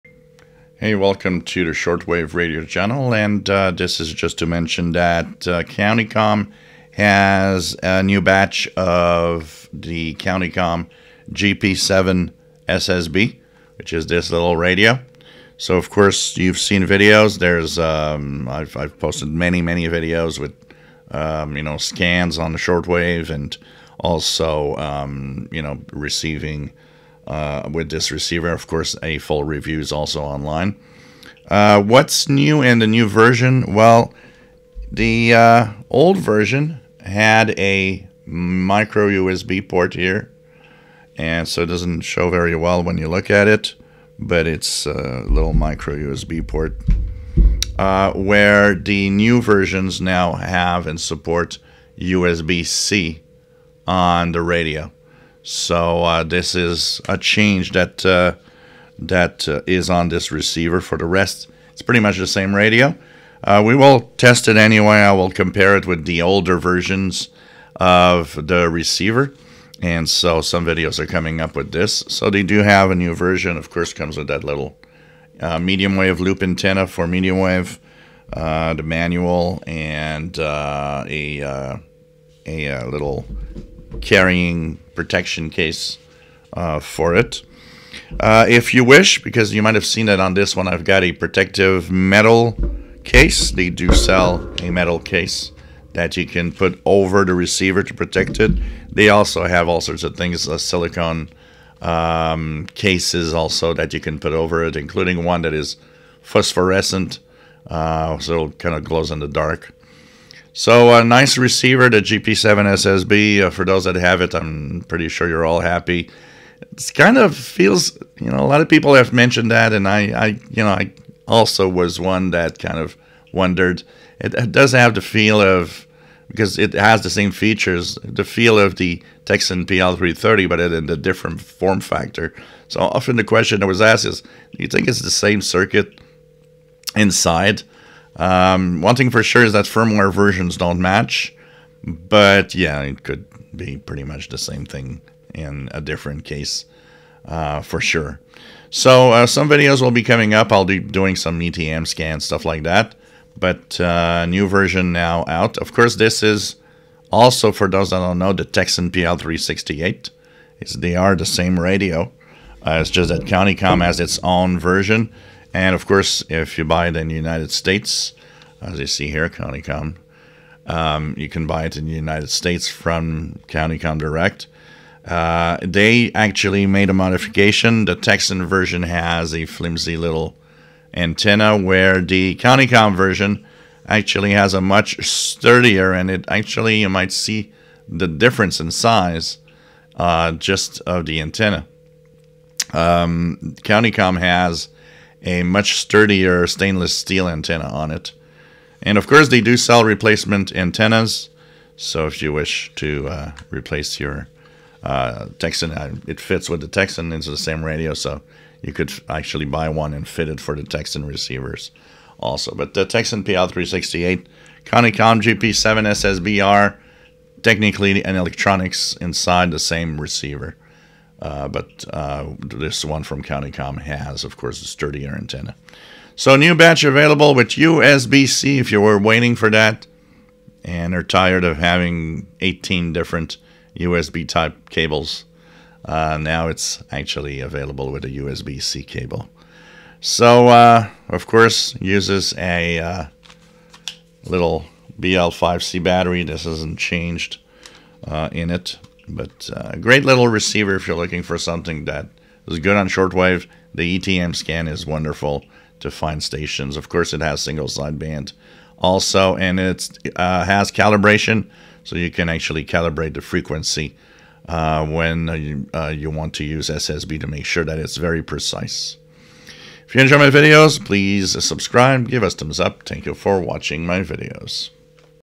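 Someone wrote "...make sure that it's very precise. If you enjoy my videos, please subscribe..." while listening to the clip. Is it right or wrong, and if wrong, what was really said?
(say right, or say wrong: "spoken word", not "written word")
right.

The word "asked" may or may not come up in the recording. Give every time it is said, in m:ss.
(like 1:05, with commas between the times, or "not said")
2:13.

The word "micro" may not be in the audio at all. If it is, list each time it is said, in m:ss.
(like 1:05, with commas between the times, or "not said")
0:38, 0:45.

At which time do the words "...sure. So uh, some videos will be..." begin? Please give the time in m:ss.
2:27.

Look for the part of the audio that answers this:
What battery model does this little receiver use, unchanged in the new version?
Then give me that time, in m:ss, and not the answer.
4:04.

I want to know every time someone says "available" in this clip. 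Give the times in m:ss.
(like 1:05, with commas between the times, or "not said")
3:46, 3:57.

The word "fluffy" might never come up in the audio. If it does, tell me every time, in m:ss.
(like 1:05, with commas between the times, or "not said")
not said.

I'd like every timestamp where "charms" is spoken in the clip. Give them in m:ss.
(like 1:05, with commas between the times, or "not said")
not said.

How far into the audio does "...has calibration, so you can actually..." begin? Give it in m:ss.
4:20.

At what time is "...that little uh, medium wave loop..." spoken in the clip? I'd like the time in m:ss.
1:14.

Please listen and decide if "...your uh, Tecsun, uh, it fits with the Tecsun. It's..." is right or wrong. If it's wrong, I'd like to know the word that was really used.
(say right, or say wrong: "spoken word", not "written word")
right.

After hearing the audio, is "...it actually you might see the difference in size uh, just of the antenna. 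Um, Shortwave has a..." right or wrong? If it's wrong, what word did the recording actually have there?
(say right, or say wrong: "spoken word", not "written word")
wrong: "CountyComm", not "Shortwave".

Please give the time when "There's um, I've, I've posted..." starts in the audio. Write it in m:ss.
0:17.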